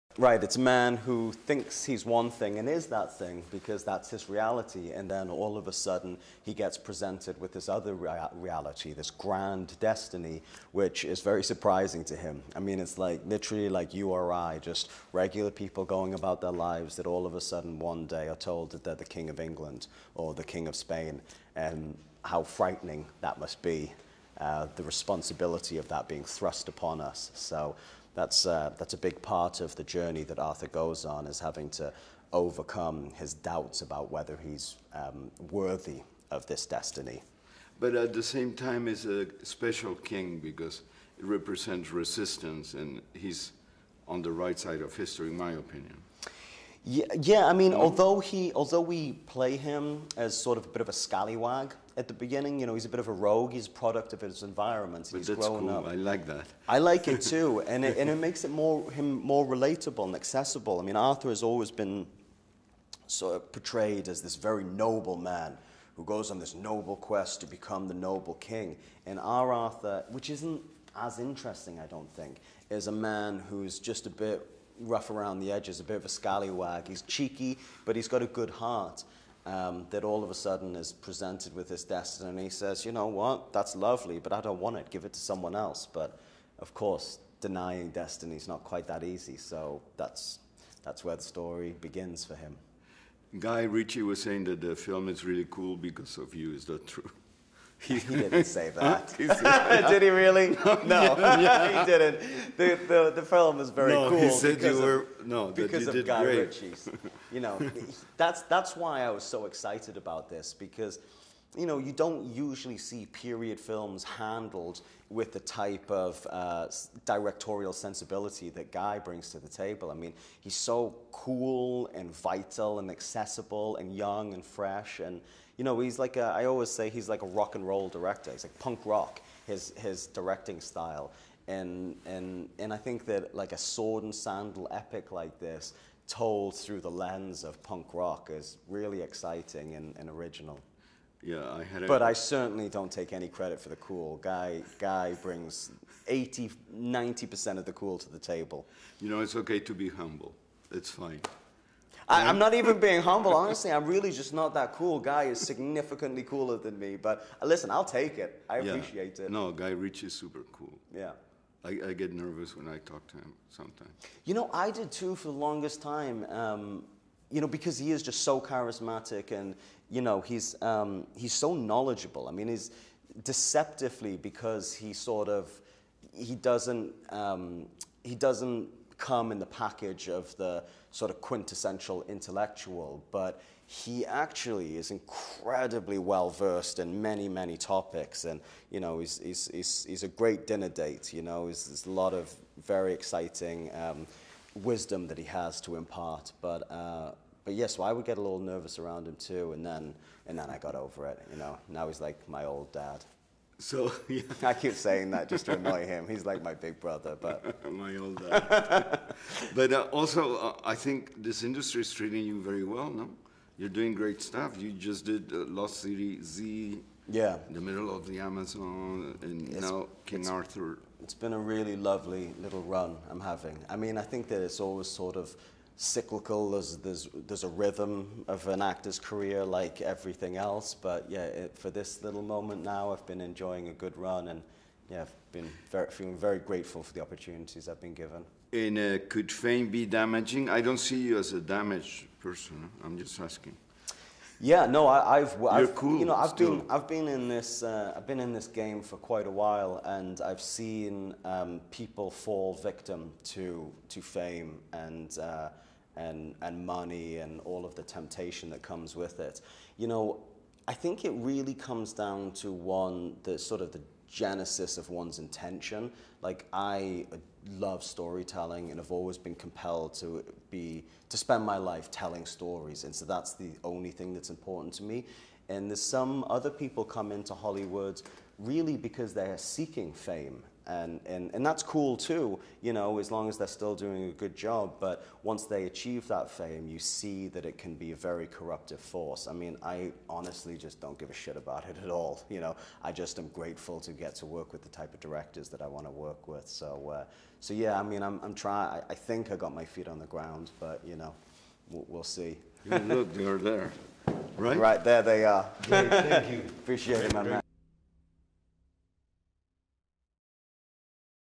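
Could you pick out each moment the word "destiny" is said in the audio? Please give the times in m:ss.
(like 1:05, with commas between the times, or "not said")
0:09, 0:36, 1:21, 1:27.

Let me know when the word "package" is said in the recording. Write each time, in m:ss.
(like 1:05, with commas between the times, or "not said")
2:59.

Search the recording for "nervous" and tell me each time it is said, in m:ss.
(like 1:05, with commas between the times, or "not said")
2:42, 3:18.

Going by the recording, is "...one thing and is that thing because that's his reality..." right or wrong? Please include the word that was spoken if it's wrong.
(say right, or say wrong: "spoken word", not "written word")
right.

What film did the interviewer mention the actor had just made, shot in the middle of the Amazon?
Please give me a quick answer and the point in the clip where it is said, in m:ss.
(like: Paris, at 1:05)
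Lost City Z, at 3:35.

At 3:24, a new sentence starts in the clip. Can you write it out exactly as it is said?
I keep saying that just to annoy him.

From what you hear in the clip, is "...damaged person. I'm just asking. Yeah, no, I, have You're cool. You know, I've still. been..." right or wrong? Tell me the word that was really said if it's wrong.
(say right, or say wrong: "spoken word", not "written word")
right.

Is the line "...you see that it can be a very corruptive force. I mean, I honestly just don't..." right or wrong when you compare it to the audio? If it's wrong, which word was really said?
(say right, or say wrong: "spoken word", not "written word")
right.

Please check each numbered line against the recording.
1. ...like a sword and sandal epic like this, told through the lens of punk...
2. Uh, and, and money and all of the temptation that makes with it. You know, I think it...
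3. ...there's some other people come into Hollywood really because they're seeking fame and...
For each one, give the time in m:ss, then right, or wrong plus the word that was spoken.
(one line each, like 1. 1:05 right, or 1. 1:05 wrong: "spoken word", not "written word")
1. 2:13 right
2. 4:15 wrong: "comes", not "makes"
3. 4:35 right.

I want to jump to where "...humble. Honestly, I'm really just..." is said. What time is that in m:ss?
2:33.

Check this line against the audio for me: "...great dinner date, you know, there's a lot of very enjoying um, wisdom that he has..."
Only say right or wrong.
wrong.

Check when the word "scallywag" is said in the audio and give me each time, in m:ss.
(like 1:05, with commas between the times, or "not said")
0:50, 1:16.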